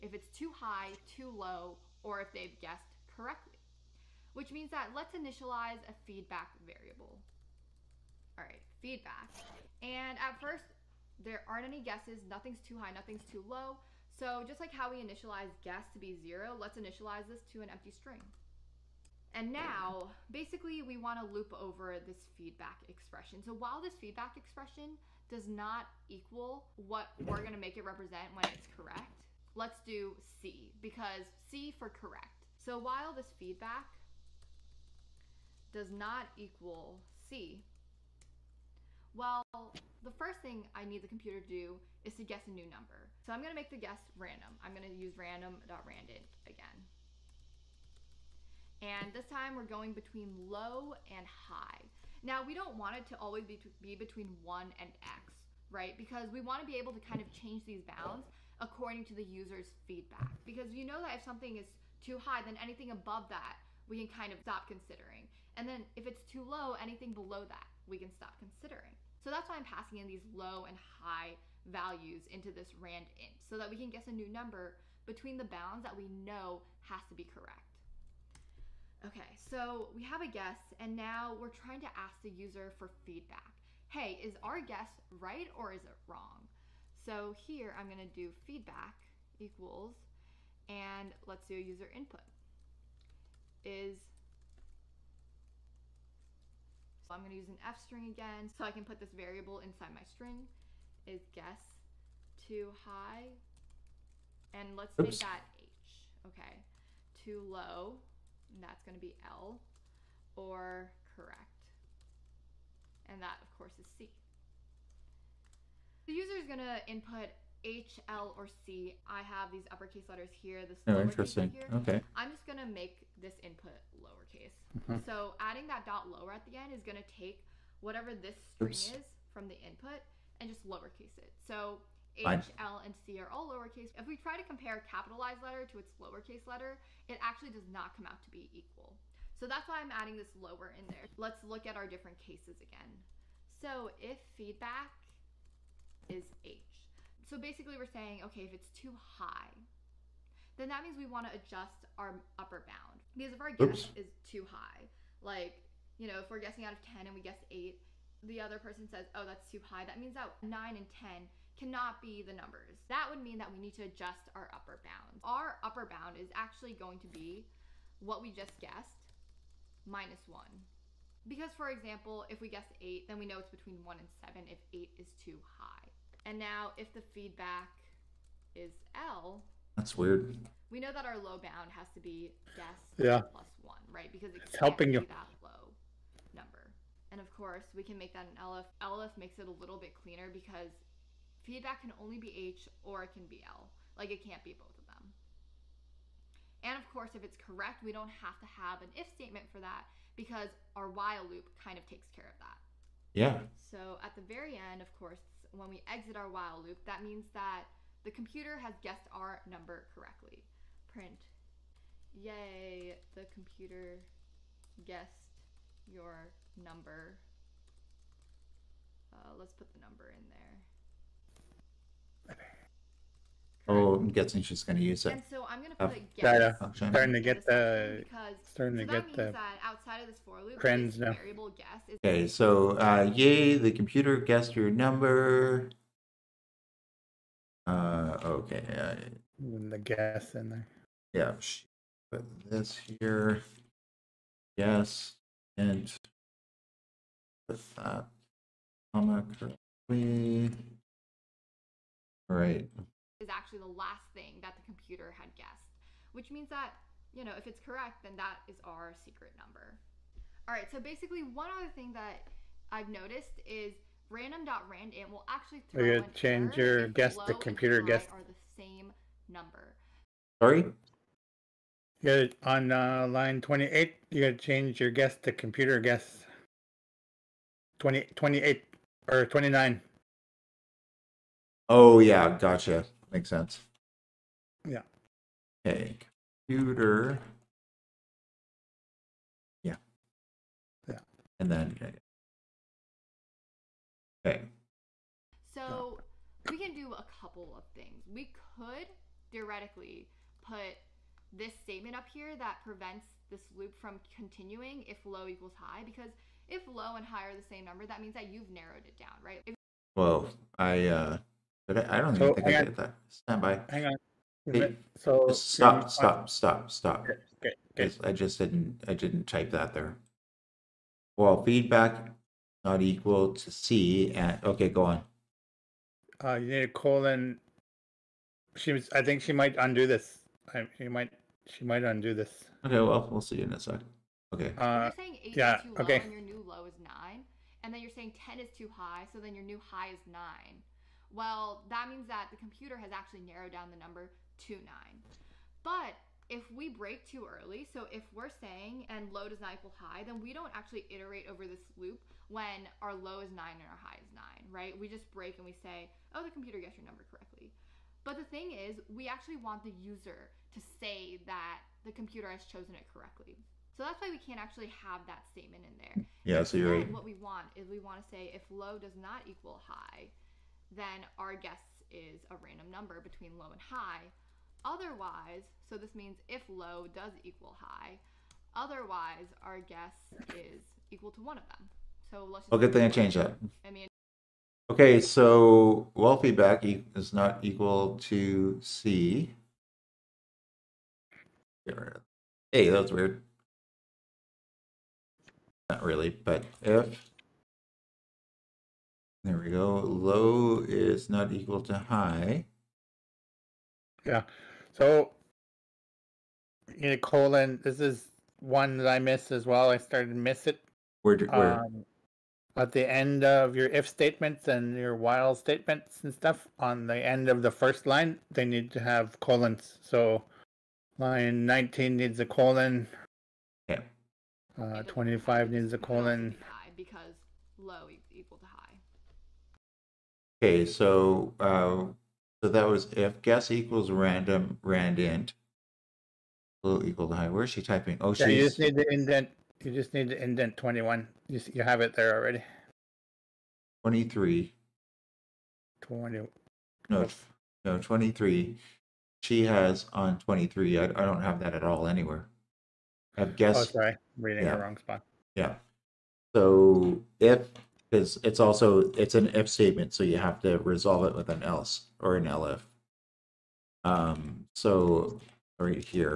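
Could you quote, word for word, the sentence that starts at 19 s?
And now, basically, we want to loop over this feedback expression.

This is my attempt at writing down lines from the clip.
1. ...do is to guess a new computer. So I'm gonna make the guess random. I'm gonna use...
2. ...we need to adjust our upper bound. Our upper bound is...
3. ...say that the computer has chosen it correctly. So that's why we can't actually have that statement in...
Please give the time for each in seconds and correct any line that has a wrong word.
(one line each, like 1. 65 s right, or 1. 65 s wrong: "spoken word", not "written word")
1. 41 s wrong: "number", not "computer"
2. 163 s right
3. 360 s right.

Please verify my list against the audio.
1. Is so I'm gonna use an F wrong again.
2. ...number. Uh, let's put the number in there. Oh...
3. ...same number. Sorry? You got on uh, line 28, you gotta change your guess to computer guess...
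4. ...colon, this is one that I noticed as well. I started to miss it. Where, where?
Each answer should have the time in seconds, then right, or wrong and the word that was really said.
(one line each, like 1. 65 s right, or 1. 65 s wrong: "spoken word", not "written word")
1. 93 s wrong: "string", not "wrong"
2. 216 s right
3. 268 s right
4. 406 s wrong: "missed", not "noticed".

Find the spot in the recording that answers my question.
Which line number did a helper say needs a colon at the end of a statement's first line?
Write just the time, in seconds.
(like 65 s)
420 s.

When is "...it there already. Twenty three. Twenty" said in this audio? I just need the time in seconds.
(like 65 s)
441 s.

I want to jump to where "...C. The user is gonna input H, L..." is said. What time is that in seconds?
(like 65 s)
113 s.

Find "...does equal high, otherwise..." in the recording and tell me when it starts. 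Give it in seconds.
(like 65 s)
376 s.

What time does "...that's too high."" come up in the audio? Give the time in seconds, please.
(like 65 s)
159 s.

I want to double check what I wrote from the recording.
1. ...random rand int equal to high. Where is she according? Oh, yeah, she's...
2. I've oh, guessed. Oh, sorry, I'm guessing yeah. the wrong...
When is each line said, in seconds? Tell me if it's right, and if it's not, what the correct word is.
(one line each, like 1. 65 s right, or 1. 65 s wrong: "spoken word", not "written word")
1. 433 s wrong: "typing", not "according"
2. 453 s wrong: "reading", not "guessing".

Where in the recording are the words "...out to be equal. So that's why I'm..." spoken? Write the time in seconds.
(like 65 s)
138 s.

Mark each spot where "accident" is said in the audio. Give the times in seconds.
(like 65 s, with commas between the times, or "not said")
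not said.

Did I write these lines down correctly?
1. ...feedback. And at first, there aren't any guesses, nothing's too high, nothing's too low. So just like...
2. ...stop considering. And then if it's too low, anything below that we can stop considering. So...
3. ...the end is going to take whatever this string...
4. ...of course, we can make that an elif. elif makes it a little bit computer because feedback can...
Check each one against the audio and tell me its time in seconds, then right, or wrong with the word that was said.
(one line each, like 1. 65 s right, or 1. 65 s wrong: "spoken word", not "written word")
1. 8 s right
2. 64 s right
3. 126 s right
4. 187 s wrong: "cleaner", not "computer".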